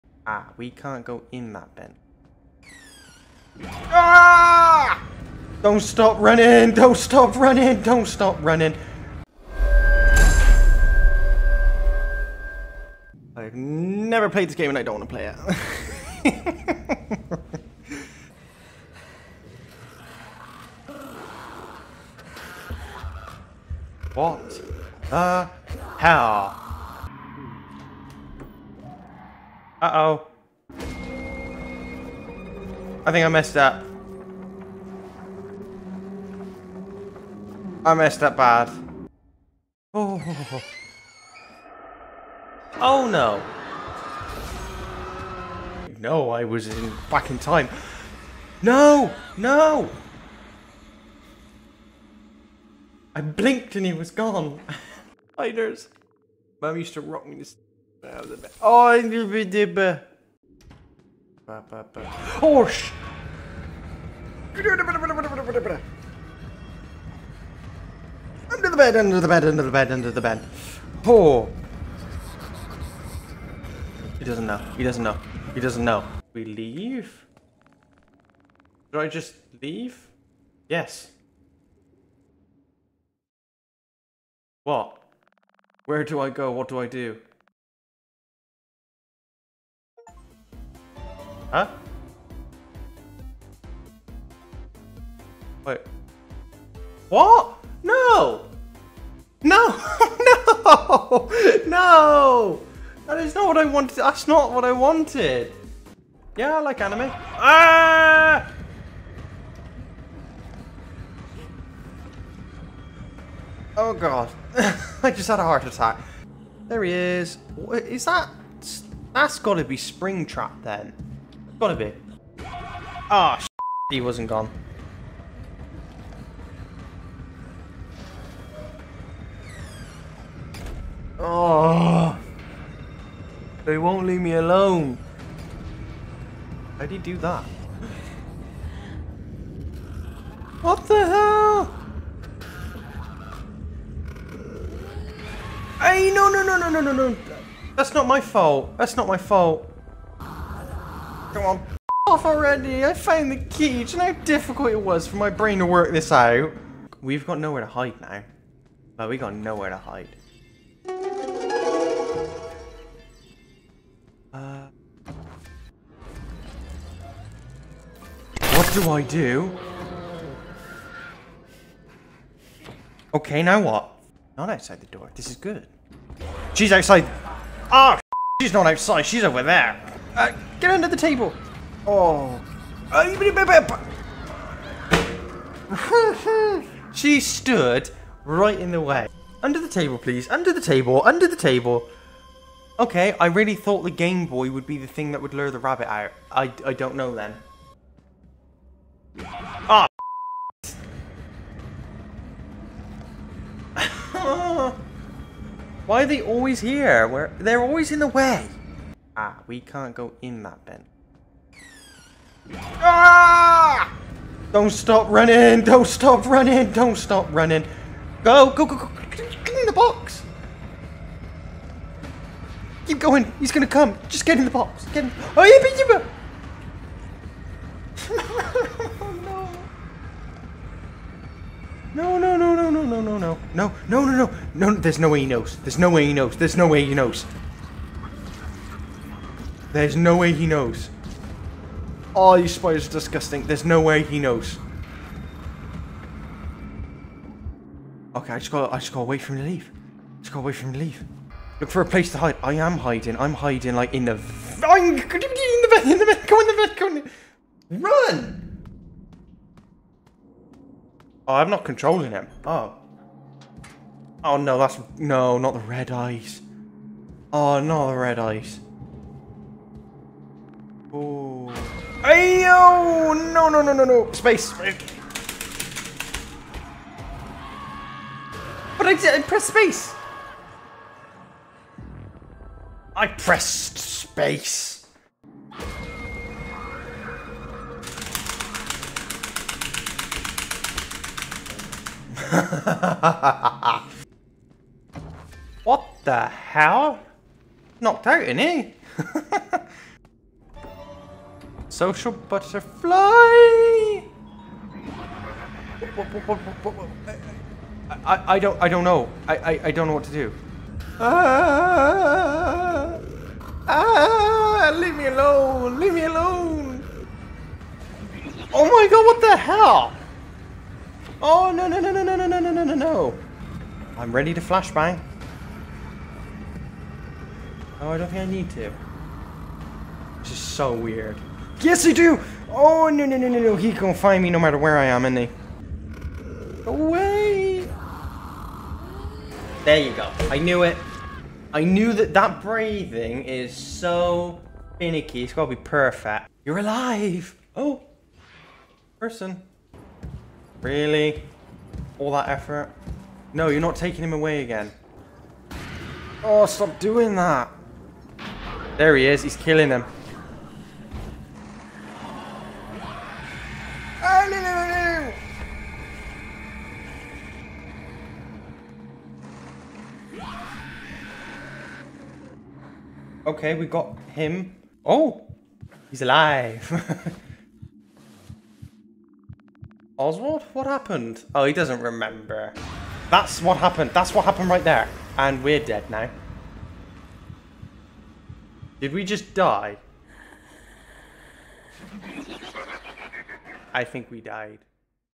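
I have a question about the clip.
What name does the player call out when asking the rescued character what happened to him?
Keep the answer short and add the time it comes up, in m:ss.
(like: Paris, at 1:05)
Oswald, at 6:19.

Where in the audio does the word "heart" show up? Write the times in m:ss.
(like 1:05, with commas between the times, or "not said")
1:55.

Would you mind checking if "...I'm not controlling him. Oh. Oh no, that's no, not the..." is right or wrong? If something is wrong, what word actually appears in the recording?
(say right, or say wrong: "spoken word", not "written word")
right.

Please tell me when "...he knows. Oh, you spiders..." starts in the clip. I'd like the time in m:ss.
4:00.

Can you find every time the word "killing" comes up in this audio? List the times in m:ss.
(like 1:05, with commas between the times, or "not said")
5:59.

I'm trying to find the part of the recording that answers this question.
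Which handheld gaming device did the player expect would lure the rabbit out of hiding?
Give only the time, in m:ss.
3:13.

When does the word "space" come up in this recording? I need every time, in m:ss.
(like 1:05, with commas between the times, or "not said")
4:34, 4:39, 4:43.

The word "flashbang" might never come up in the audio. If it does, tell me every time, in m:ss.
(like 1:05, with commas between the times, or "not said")
5:24.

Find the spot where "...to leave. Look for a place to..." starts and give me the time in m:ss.
4:10.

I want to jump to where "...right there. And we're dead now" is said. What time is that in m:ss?
6:24.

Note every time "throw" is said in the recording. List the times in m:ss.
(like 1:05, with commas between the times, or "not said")
not said.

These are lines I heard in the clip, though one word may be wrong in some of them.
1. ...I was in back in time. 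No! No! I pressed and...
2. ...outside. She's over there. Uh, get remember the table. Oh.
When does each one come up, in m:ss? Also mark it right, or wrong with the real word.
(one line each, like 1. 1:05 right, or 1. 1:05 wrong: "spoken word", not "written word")
1. 0:46 wrong: "blinked", not "pressed"
2. 2:58 wrong: "under", not "remember".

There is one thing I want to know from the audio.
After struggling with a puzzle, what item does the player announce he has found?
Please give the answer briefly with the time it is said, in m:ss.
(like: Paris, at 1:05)
The key, at 2:33.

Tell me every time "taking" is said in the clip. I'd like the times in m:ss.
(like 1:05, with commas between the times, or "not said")
5:53.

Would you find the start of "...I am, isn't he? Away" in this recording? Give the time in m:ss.
5:34.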